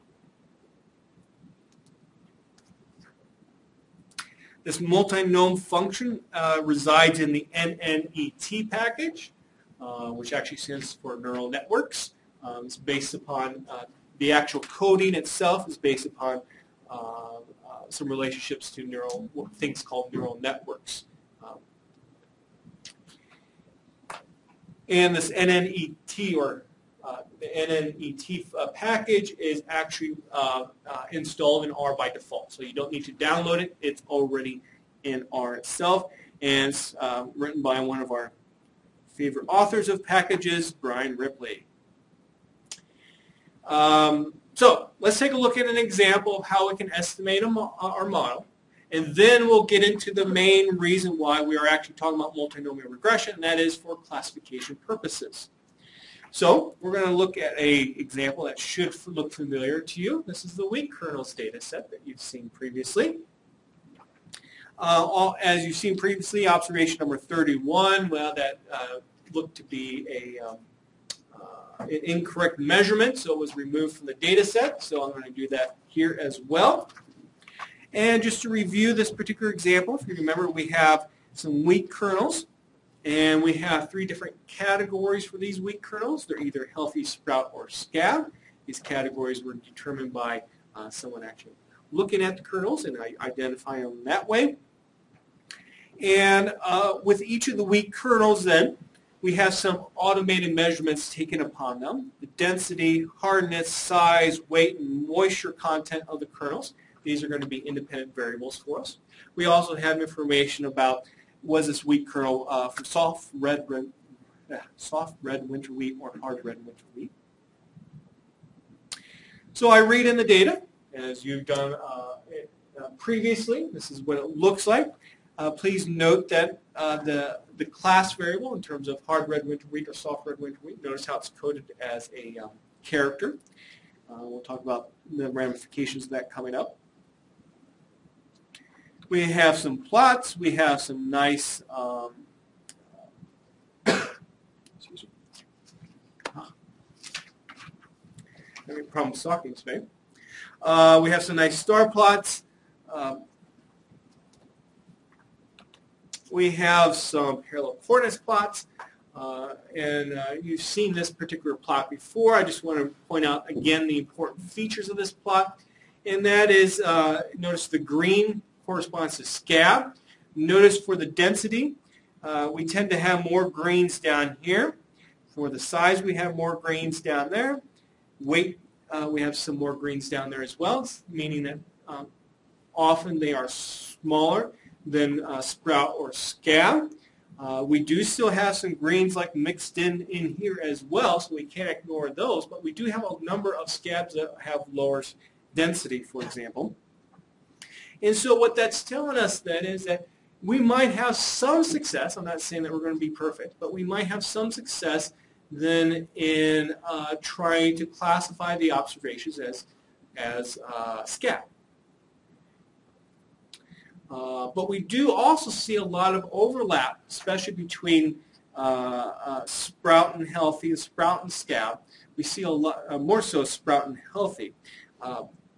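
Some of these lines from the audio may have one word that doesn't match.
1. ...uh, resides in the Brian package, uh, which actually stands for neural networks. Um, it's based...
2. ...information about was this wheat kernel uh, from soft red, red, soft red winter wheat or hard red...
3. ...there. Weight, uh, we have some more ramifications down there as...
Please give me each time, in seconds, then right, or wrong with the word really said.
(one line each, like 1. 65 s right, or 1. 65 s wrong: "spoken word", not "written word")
1. 6 s wrong: "NNET", not "Brian"
2. 110 s right
3. 177 s wrong: "grains", not "ramifications".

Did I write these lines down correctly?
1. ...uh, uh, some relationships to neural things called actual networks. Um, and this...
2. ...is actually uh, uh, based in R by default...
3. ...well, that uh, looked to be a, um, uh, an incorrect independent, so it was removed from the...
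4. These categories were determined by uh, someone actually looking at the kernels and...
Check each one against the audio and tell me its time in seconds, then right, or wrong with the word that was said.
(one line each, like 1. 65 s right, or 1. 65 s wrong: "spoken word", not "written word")
1. 16 s wrong: "neural", not "actual"
2. 29 s wrong: "installed", not "based"
3. 68 s wrong: "measurement", not "independent"
4. 88 s right.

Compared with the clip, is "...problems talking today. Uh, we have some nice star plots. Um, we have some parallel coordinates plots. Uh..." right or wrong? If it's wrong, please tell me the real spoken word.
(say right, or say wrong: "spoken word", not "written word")
right.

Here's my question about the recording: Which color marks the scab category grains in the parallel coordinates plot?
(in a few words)
green.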